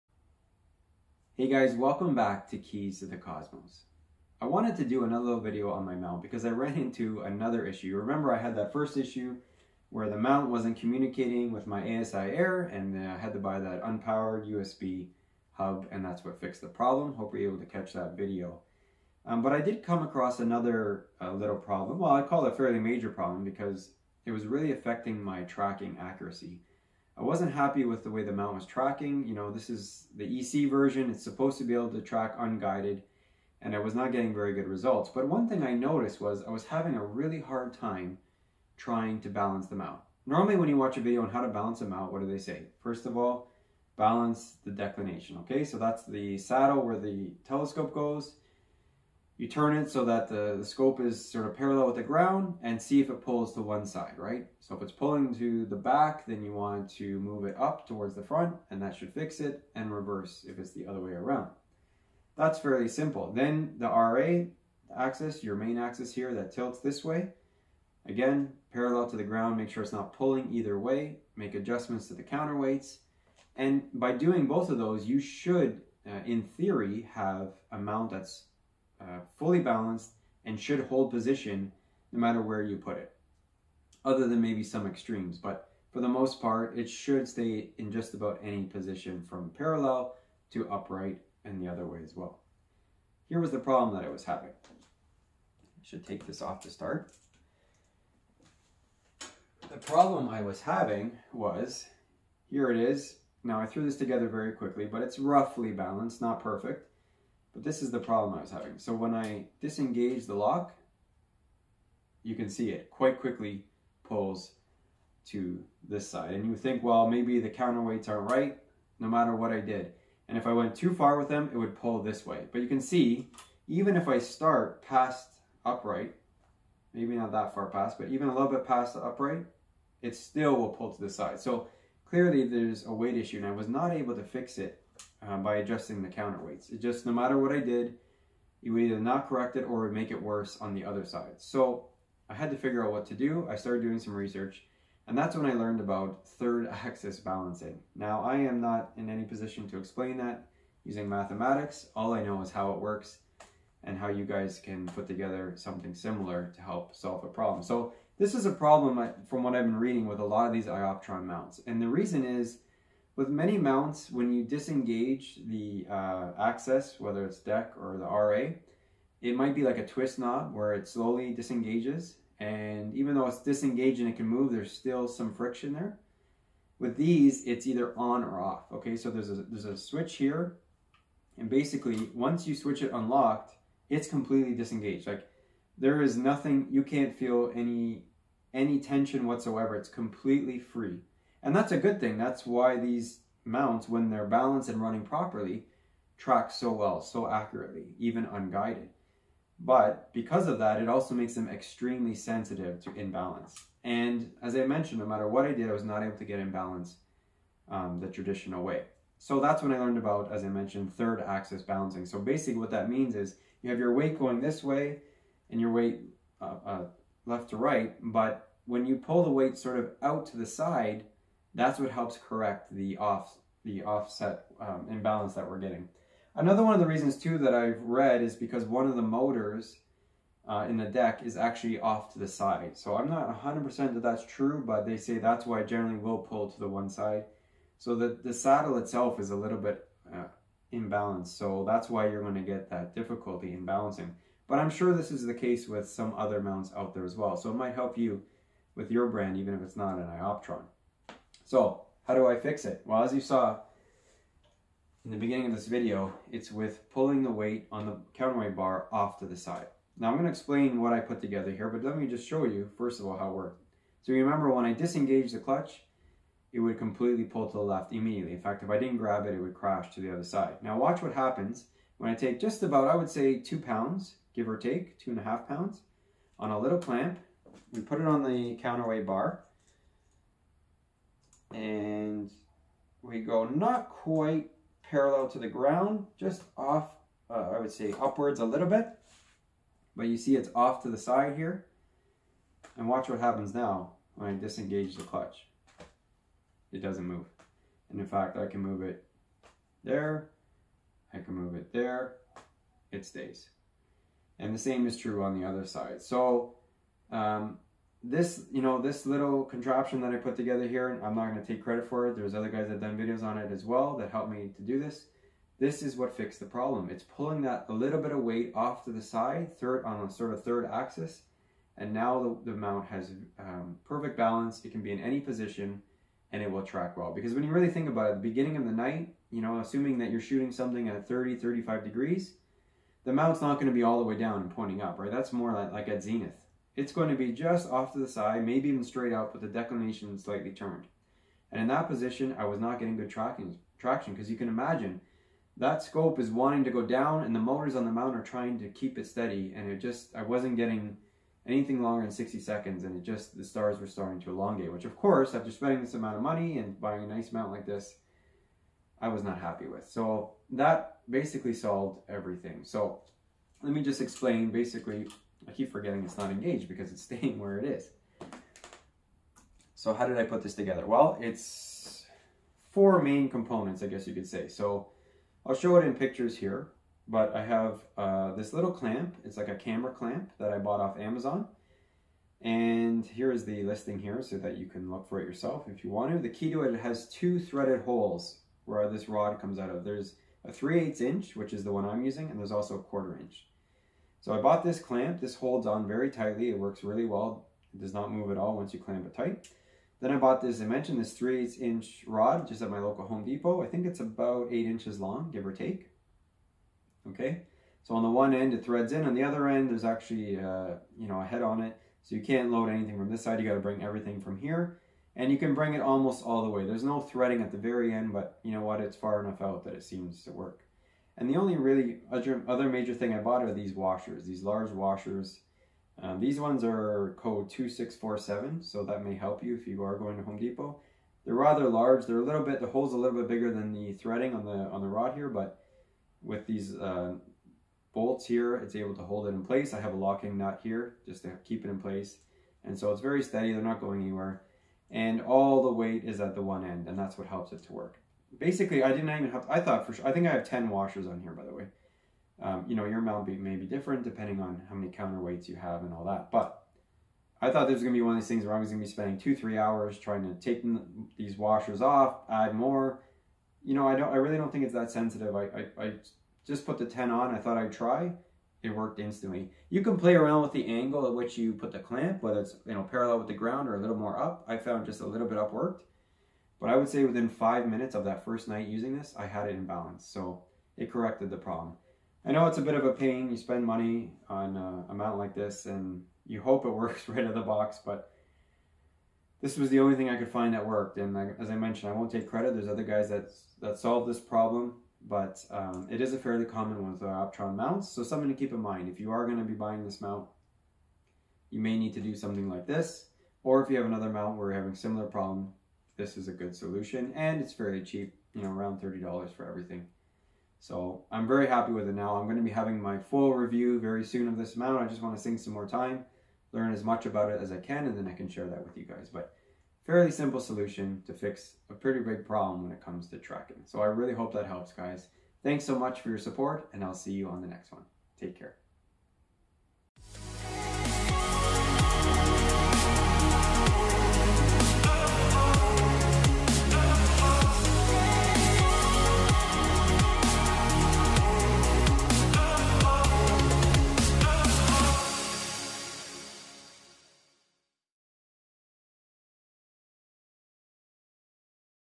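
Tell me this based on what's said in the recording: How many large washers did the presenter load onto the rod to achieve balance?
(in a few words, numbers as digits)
10.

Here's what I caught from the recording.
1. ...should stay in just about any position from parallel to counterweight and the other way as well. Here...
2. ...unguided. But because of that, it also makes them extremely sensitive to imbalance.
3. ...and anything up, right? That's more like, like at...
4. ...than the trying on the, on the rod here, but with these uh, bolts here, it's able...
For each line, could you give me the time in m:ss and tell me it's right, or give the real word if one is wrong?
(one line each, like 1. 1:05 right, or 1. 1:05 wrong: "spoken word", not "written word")
1. 1:26 wrong: "upright", not "counterweight"
2. 3:18 right
3. 5:34 wrong: "pointing", not "anything"
4. 7:13 wrong: "threading", not "trying".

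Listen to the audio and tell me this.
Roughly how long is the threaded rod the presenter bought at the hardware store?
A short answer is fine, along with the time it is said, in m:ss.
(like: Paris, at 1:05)
8 inches, at 6:44.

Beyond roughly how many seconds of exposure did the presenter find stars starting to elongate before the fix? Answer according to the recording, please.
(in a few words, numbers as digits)
60 seconds.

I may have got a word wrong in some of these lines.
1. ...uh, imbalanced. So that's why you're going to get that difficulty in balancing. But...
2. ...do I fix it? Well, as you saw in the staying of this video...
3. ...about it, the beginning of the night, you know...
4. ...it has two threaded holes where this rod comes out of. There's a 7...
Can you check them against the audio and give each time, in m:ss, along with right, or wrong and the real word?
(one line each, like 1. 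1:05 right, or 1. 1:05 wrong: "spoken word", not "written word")
1. 4:00 right
2. 4:12 wrong: "beginning", not "staying"
3. 5:27 right
4. 6:26 wrong: "3", not "7".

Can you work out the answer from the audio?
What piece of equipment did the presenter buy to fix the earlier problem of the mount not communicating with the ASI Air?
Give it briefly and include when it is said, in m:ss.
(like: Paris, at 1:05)
unpowered USB hub, at 0:13.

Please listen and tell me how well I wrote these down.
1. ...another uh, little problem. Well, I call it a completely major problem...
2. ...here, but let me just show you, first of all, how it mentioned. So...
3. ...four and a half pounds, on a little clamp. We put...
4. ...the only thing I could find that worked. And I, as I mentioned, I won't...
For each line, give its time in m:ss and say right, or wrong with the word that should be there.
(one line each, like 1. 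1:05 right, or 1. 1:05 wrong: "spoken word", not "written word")
1. 0:20 wrong: "fairly", not "completely"
2. 4:21 wrong: "worked", not "mentioned"
3. 4:34 wrong: "two", not "four"
4. 8:09 right.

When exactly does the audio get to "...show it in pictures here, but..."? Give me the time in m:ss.
6:15.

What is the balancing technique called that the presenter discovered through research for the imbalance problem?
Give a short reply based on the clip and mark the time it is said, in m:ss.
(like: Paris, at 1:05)
third axis balancing, at 2:26.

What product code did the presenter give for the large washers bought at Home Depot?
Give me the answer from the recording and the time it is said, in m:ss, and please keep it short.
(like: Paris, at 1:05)
2647, at 7:07.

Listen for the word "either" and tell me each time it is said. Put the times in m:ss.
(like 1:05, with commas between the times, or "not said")
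1:10, 2:18, 2:57.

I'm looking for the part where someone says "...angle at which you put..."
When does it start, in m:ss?
7:50.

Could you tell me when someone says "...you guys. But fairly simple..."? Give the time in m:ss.
8:38.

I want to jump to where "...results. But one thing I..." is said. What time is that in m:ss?
0:34.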